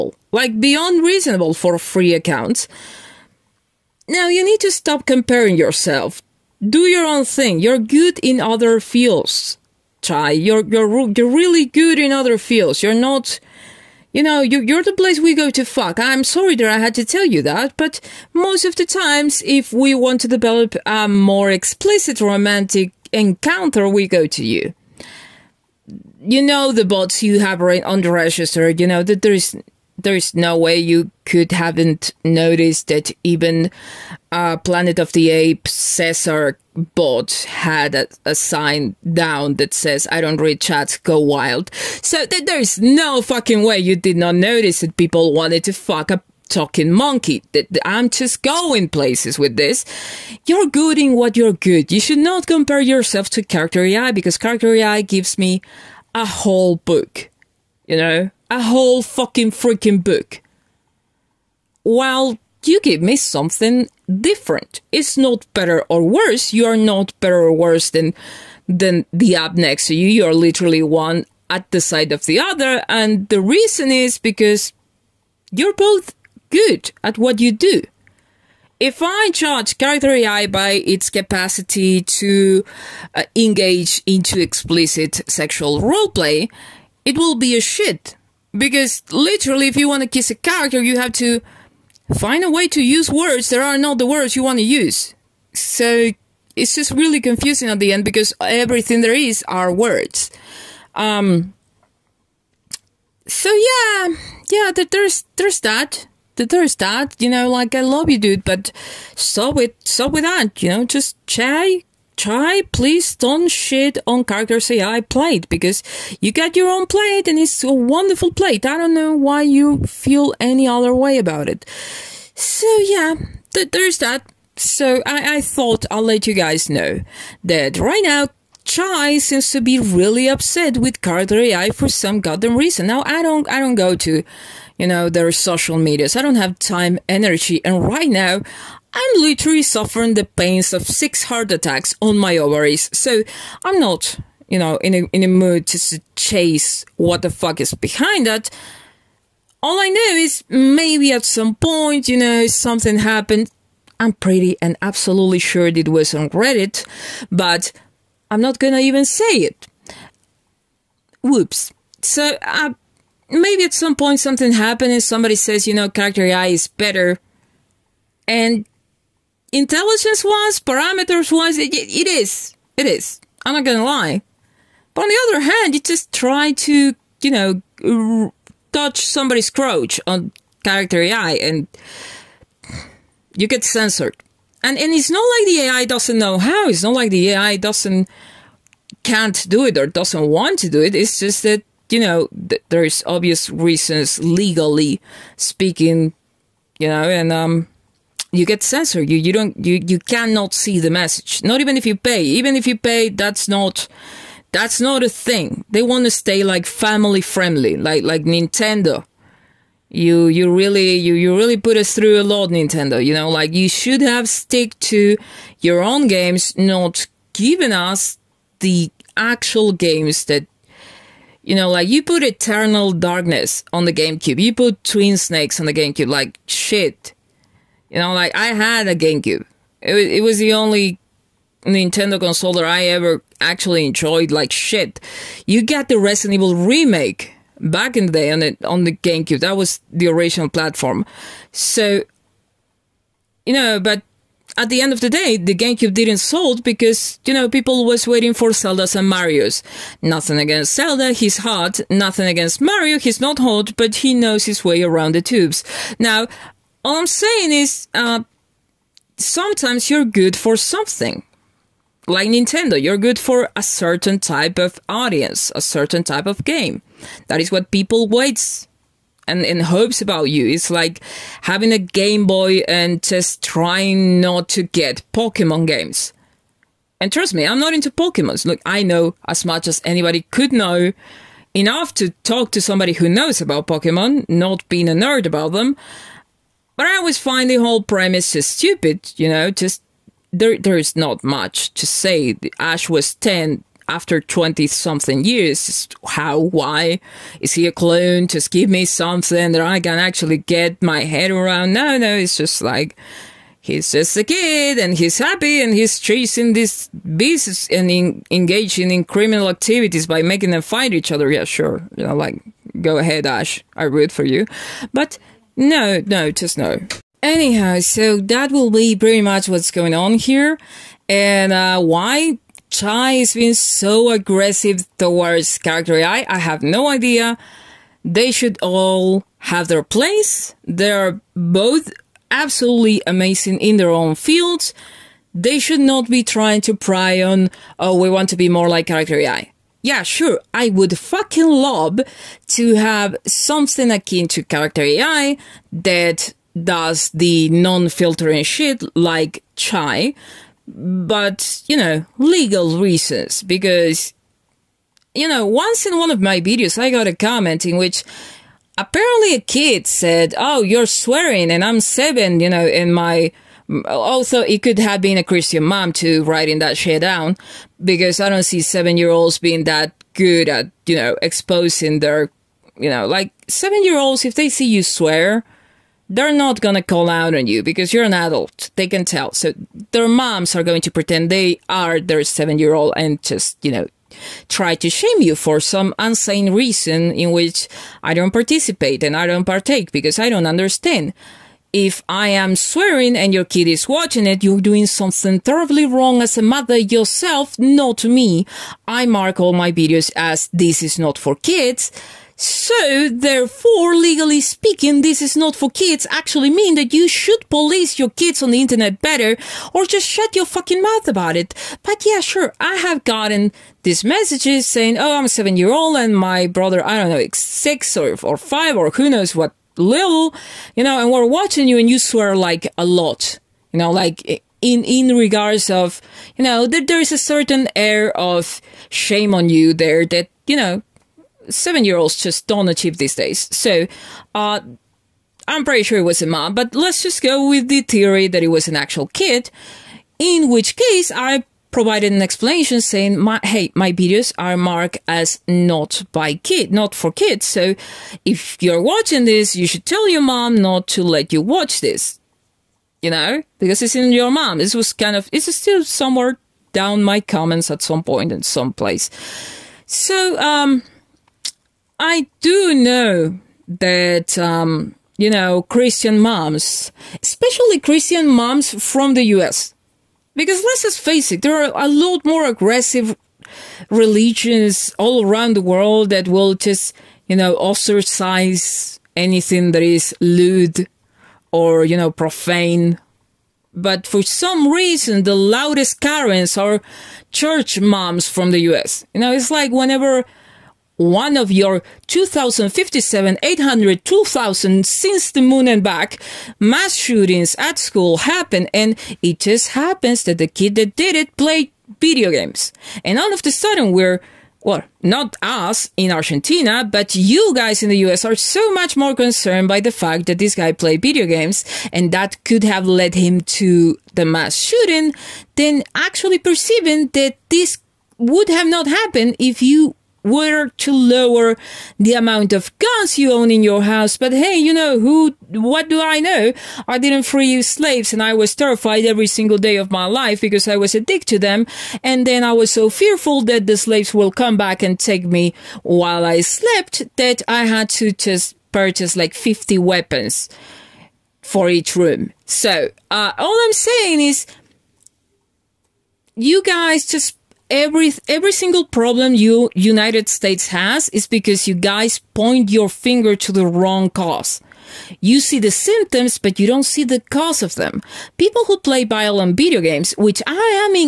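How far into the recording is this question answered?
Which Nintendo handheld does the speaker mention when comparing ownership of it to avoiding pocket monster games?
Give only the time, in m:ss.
4:31.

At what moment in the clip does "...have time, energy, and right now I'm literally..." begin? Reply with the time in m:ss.
2:16.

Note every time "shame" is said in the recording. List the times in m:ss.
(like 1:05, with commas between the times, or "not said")
6:24, 7:08.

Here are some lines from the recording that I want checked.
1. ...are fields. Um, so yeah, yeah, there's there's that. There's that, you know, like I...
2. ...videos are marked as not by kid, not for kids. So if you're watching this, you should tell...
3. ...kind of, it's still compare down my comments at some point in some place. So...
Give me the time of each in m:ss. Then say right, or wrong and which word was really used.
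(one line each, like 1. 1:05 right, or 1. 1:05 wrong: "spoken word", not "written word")
1. 1:39 wrong: "words", not "fields"
2. 7:23 right
3. 7:34 wrong: "somewhere", not "compare".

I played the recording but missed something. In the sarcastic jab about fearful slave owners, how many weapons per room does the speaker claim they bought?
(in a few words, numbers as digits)
50.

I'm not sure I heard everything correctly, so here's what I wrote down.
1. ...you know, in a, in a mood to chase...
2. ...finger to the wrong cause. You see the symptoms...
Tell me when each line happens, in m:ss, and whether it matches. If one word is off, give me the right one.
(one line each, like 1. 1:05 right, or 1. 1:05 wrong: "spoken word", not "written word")
1. 2:24 right
2. 9:12 right.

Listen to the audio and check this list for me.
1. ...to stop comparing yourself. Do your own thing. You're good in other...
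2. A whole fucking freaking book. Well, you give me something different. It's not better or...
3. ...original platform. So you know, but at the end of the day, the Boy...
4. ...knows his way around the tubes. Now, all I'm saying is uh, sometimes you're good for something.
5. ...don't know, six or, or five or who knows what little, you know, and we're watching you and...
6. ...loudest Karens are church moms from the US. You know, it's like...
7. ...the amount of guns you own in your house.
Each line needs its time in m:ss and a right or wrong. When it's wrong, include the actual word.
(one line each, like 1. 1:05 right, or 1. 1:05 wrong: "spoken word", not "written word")
1. 0:04 right
2. 0:58 right
3. 4:00 wrong: "GameCube", not "Boy"
4. 4:14 right
5. 6:56 right
6. 8:05 right
7. 8:41 right.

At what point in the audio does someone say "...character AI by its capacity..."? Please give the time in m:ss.
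1:19.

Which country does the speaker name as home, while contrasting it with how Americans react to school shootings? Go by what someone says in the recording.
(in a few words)
Argentina.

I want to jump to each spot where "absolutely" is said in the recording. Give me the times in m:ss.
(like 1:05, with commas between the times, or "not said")
2:34, 5:32.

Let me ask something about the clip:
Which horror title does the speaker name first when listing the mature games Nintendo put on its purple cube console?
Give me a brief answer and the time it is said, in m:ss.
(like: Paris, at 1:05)
Eternal Darkness, at 3:42.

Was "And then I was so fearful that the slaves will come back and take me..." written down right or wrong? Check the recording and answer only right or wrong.
right.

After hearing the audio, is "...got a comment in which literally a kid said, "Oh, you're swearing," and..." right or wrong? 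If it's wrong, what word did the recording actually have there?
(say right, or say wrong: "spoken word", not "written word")
wrong: "apparently", not "literally".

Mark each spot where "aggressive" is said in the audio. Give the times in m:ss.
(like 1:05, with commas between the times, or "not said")
5:24, 7:52.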